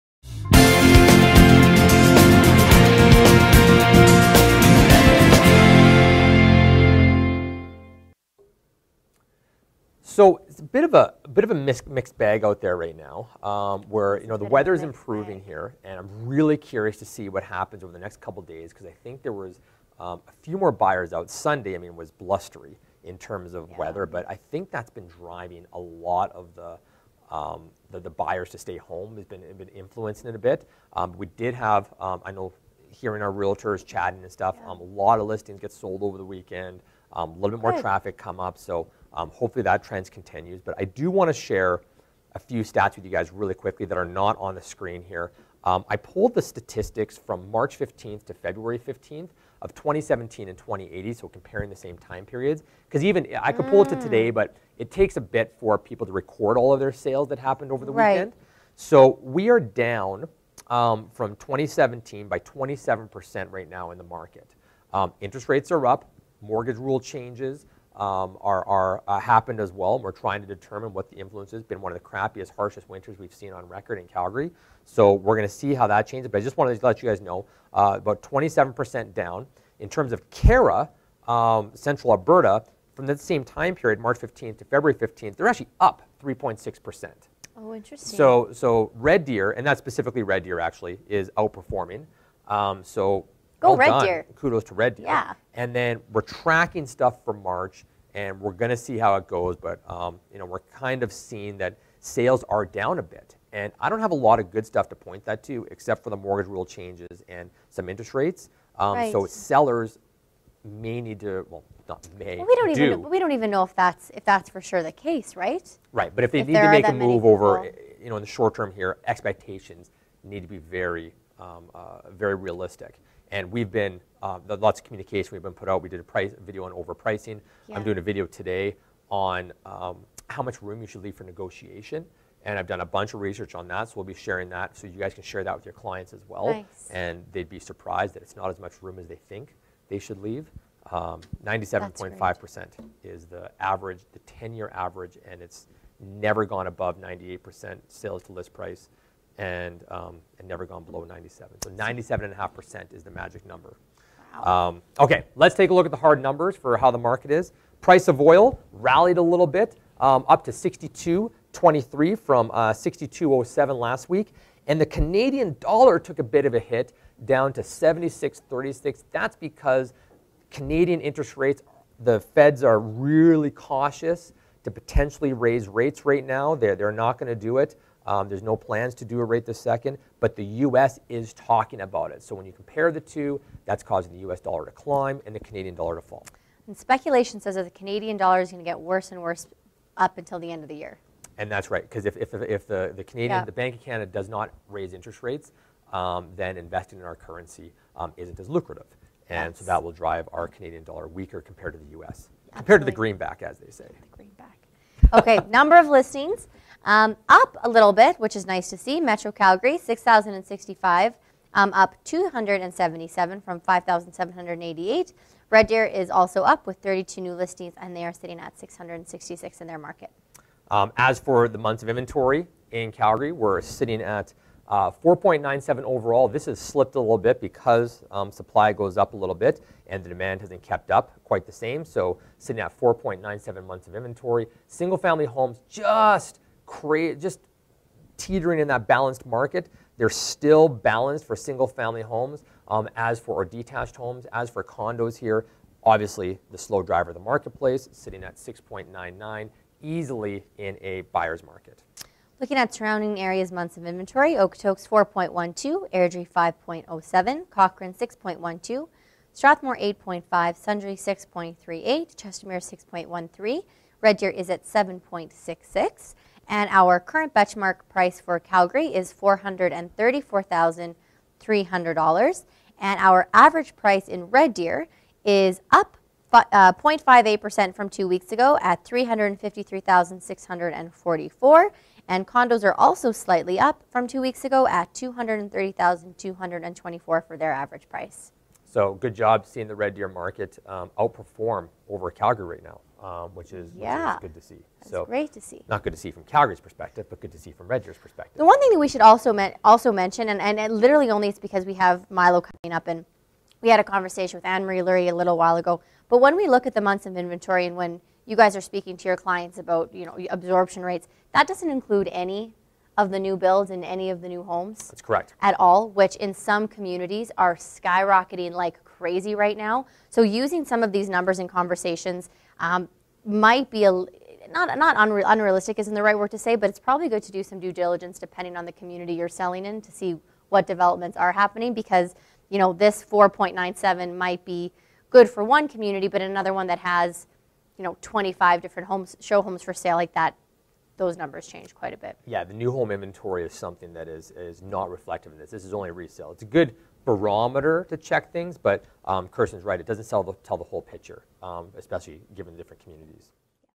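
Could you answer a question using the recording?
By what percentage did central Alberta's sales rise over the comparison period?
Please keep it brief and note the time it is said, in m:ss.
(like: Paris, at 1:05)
3.6%, at 1:26.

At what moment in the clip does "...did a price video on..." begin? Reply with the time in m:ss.
2:05.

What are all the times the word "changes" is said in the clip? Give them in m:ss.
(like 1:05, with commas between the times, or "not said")
1:06, 1:16, 1:46, 5:41.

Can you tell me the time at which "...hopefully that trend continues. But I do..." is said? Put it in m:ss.
0:39.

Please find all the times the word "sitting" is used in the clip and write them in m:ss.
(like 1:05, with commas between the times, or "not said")
3:38, 3:43, 3:52, 4:07.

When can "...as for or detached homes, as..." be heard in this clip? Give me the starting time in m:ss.
4:02.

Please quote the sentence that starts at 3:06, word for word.
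And speculation says that the Canadian dollar is going to get worse and worse up until the end of the year.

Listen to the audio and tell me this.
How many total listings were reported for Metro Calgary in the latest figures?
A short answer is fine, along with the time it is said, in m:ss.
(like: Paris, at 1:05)
6,065, at 3:29.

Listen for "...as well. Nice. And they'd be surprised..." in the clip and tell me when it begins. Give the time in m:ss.
2:16.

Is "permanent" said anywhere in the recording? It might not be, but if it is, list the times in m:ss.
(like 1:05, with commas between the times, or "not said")
not said.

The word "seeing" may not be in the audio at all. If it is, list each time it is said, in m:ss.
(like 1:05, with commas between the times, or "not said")
1:41, 4:49.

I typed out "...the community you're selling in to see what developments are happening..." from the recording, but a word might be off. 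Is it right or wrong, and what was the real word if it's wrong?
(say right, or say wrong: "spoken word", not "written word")
right.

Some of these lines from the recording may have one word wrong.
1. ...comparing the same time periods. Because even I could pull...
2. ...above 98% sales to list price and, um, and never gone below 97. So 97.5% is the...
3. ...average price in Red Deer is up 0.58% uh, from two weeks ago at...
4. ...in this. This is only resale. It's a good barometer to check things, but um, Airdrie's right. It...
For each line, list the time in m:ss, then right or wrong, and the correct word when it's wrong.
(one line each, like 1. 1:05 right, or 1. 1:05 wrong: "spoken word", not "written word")
1. 0:51 right
2. 2:26 right
3. 4:33 right
4. 5:45 wrong: "Kirsten", not "Airdrie".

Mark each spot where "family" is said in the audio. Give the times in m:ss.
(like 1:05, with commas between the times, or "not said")
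3:54, 4:01.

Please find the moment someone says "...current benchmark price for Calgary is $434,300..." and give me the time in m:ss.
4:26.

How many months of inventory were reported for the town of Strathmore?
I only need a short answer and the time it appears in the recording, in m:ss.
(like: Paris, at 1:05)
8.5, at 4:19.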